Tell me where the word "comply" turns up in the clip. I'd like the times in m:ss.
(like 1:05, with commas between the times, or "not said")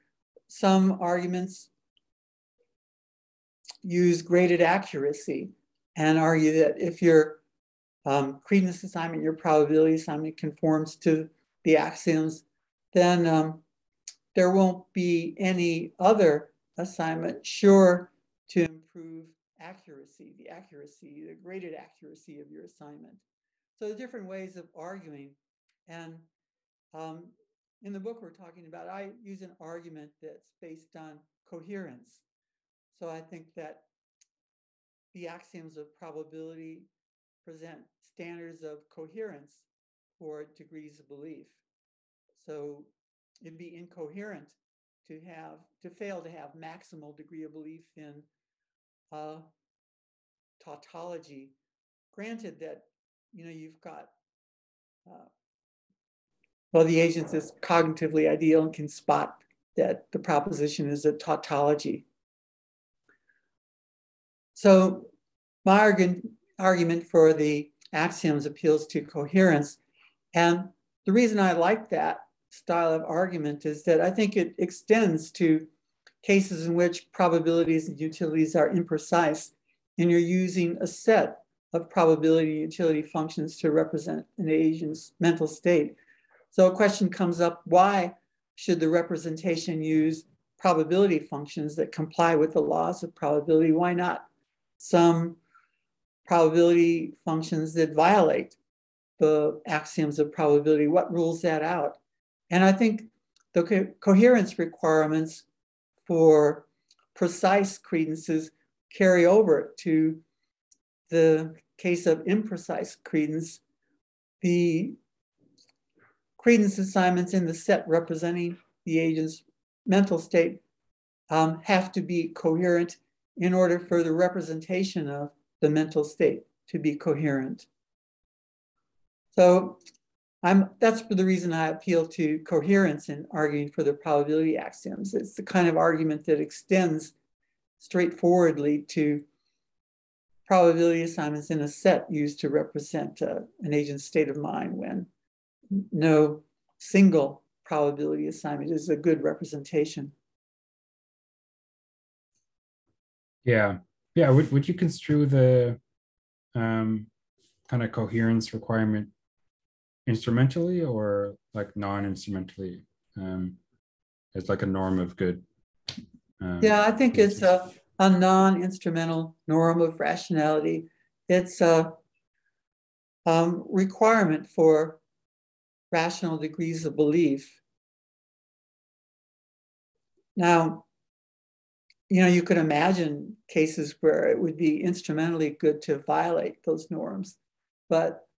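1:31.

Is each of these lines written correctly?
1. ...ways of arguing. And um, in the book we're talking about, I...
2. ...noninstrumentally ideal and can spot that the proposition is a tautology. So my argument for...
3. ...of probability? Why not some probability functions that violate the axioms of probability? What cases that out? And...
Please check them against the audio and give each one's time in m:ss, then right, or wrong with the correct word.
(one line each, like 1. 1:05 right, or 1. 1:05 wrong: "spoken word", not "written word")
1. 0:24 right
2. 0:57 wrong: "cognitively", not "noninstrumentally"
3. 1:33 wrong: "rules", not "cases".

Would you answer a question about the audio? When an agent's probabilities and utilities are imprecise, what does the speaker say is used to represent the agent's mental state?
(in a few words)
a set of probability utility functions.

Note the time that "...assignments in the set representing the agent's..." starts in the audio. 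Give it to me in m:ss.
1:56.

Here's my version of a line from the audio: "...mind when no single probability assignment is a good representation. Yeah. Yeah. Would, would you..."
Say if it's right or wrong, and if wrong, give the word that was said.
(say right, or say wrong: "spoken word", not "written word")
right.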